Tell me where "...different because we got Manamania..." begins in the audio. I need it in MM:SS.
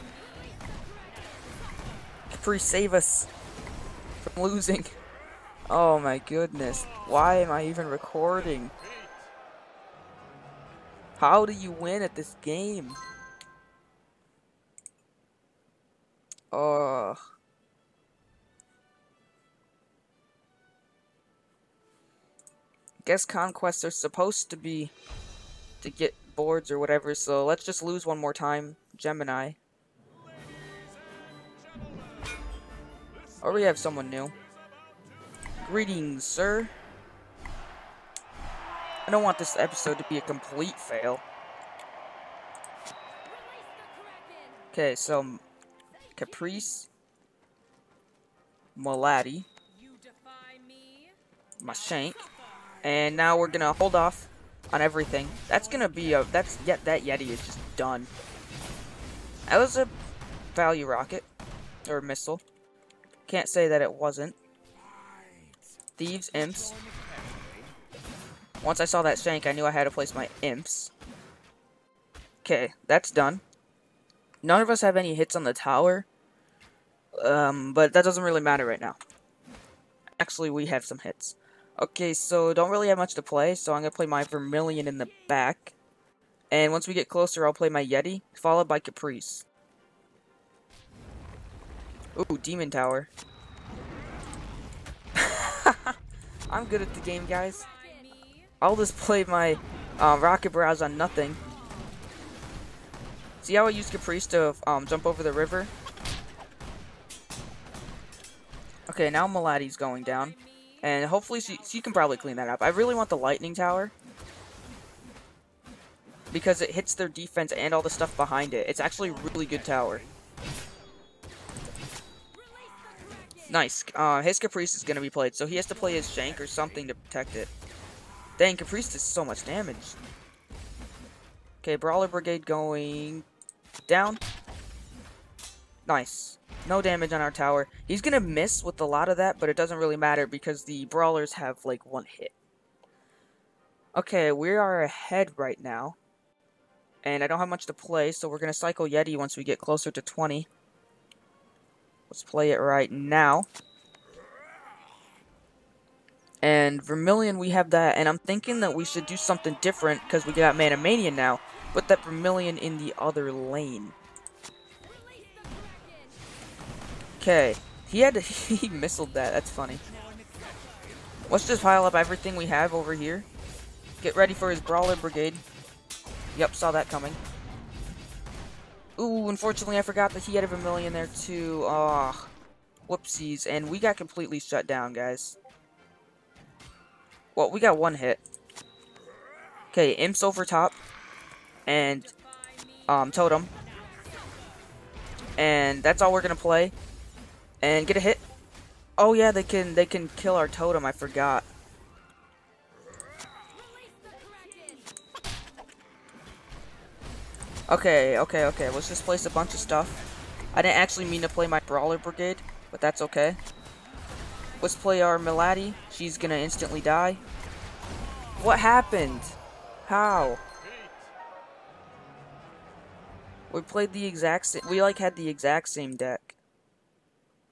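02:39.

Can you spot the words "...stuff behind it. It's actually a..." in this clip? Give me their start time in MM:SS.
01:57.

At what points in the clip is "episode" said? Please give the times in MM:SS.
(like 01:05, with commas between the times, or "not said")
00:39.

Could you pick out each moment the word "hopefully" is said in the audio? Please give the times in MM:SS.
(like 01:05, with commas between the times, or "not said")
01:51.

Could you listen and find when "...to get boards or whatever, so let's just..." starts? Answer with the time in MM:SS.
00:25.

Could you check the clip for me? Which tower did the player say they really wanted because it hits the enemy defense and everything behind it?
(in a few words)
lightning tower.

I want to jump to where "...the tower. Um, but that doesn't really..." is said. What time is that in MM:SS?
01:15.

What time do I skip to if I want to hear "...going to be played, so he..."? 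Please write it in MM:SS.
02:04.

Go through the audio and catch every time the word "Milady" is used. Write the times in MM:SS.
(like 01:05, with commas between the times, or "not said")
03:35.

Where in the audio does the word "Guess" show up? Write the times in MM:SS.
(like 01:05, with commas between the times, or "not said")
00:23.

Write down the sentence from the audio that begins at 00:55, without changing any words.
That's gonna be a that's yet yeah, that Yeti is just done.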